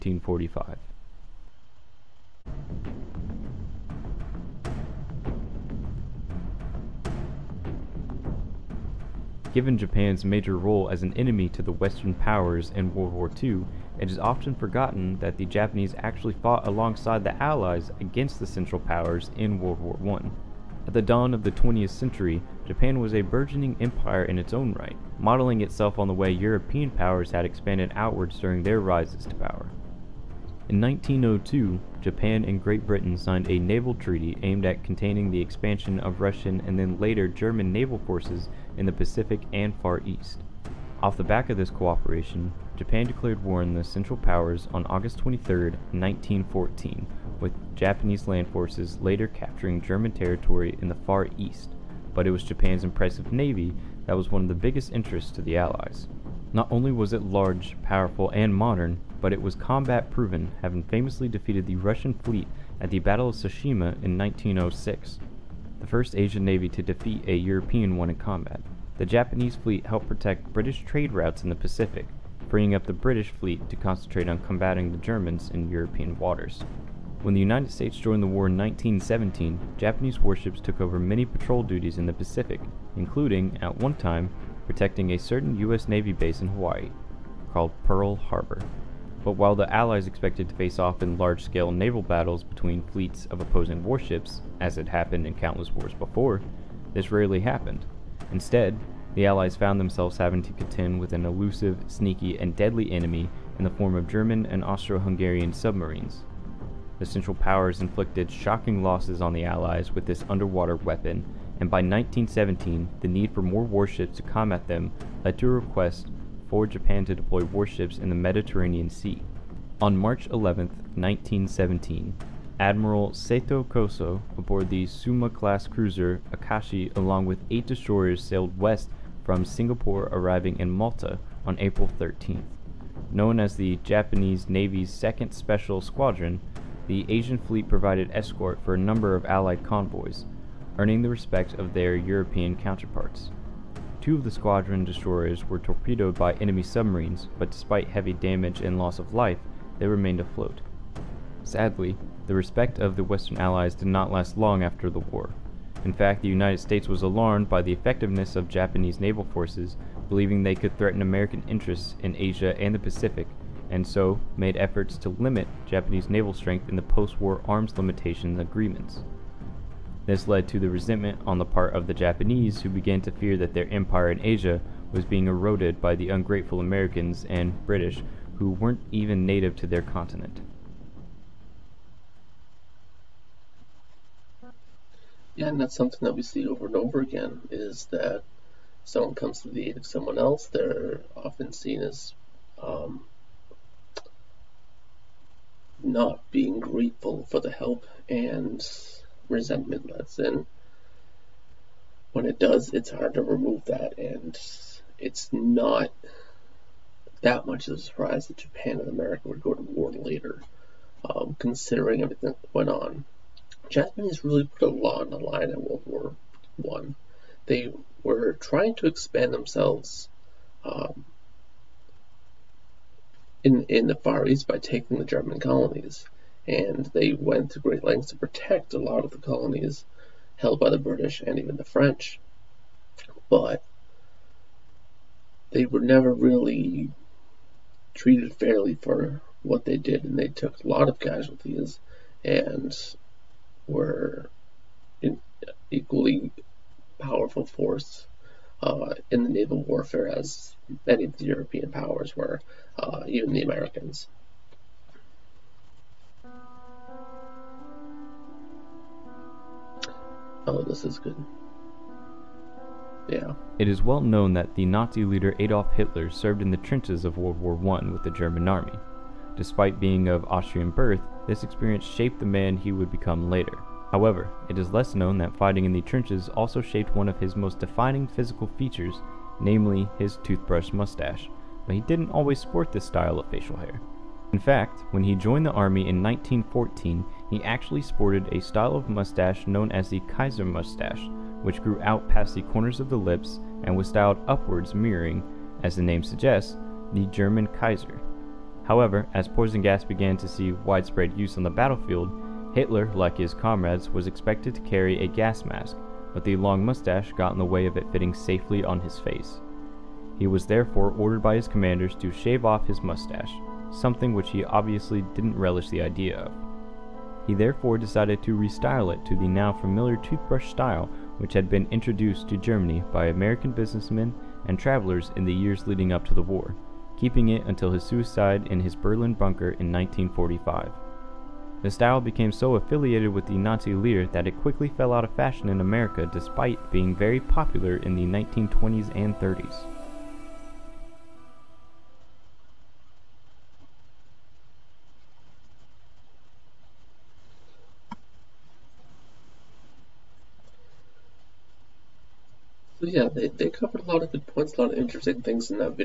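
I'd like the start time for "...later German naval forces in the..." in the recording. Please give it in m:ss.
0:36.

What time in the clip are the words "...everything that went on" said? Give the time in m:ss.
3:32.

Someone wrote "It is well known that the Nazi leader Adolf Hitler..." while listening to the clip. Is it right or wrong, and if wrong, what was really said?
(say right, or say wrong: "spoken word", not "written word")
right.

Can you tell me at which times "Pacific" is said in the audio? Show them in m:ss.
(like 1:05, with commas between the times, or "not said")
0:38, 1:11, 1:22, 2:42.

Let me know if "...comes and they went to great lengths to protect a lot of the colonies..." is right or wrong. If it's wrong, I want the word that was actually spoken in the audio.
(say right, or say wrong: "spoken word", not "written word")
wrong: "colonies", not "comes".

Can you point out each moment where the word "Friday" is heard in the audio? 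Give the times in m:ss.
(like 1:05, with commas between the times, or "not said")
not said.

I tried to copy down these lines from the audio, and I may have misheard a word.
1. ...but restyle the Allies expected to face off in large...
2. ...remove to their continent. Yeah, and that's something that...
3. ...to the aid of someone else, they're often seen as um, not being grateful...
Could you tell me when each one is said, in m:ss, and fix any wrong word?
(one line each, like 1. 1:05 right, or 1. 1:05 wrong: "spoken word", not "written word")
1. 1:29 wrong: "while", not "restyle"
2. 2:59 wrong: "native", not "remove"
3. 3:09 right.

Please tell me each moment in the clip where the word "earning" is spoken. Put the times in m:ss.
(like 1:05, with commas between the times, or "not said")
2:20.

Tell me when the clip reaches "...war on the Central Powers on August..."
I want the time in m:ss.
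0:43.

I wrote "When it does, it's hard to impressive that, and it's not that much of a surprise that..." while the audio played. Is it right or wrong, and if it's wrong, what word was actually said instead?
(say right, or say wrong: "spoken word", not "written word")
wrong: "remove", not "impressive".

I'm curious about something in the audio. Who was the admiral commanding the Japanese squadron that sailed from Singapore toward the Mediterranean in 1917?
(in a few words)
Sato Kozo.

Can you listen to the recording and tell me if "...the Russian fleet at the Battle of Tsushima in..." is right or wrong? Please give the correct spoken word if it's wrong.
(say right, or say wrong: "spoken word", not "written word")
right.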